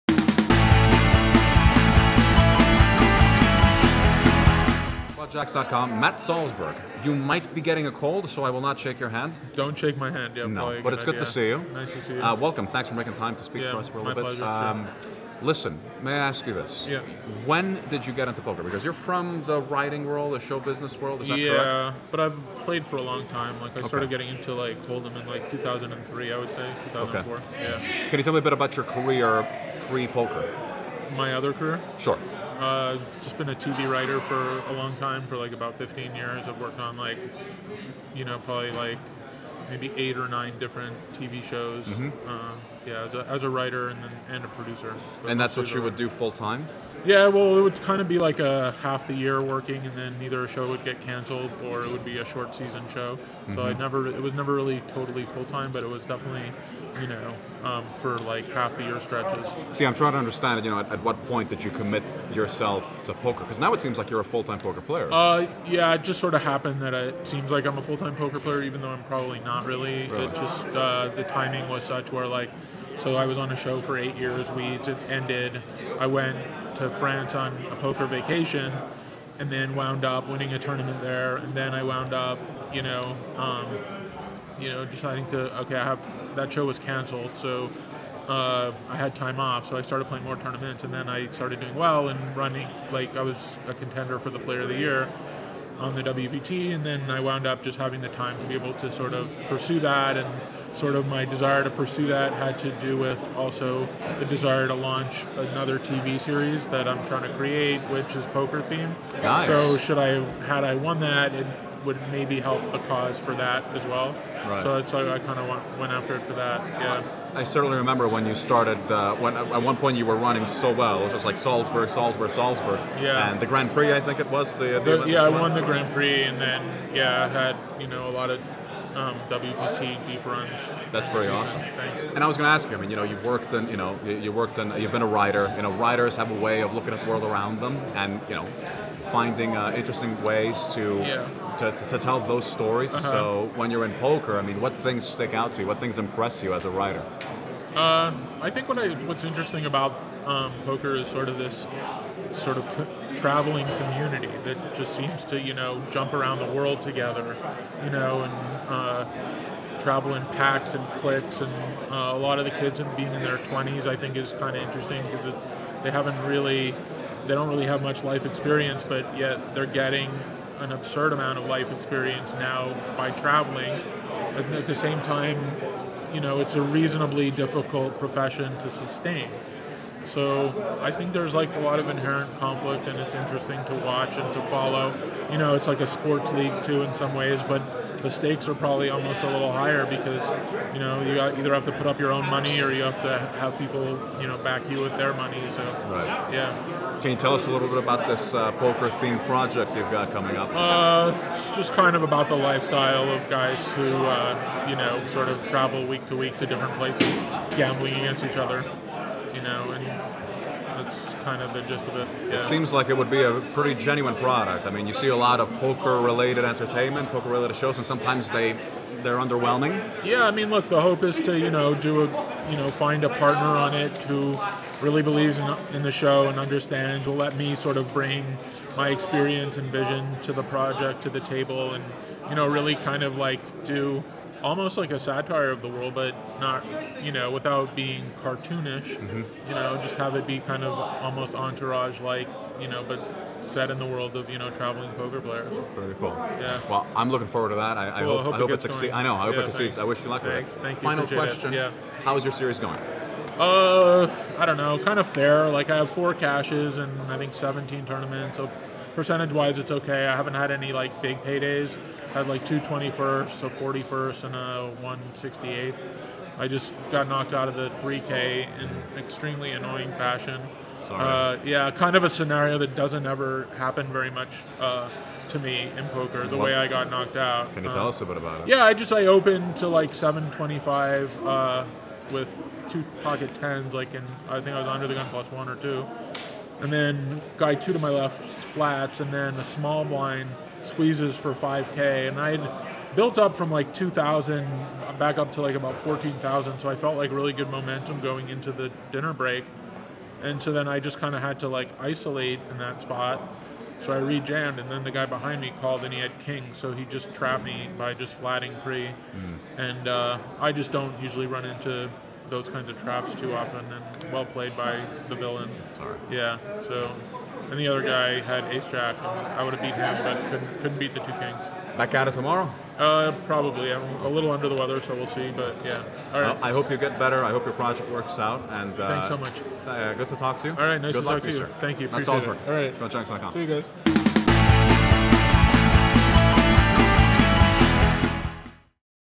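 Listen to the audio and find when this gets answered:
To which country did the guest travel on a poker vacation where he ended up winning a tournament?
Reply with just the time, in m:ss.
1:16.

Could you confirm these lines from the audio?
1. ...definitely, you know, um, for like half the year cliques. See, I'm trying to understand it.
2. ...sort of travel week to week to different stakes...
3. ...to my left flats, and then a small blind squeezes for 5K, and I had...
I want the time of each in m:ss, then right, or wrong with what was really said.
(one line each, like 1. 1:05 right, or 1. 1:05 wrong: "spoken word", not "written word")
1. 0:56 wrong: "stretches", not "cliques"
2. 3:25 wrong: "places", not "stakes"
3. 4:47 right.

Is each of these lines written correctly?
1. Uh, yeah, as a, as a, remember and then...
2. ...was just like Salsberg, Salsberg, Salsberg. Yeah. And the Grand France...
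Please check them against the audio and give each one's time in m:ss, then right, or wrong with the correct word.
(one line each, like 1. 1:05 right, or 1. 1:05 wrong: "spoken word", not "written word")
1. 0:42 wrong: "writer", not "remember"
2. 2:01 wrong: "Prix", not "France".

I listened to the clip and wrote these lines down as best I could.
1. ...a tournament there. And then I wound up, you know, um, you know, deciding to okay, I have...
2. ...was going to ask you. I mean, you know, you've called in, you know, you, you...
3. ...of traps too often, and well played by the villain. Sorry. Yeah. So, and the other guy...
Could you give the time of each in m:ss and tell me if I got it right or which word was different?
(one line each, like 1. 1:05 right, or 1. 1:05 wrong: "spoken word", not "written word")
1. 1:20 right
2. 2:12 wrong: "worked", not "called"
3. 5:12 right.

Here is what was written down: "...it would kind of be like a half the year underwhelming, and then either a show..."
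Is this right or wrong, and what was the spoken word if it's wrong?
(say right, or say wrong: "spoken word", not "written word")
wrong: "working", not "underwhelming".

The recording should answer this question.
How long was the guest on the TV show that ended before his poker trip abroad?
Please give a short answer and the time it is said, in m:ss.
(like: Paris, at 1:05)
eight years, at 1:13.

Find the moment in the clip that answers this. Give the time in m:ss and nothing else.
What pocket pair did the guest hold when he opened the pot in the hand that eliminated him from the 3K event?
4:43.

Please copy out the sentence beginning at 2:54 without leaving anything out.
at the same time, you know, it's a reasonably difficult profession to sustain.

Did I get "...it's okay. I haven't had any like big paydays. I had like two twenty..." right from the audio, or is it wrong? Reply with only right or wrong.
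right.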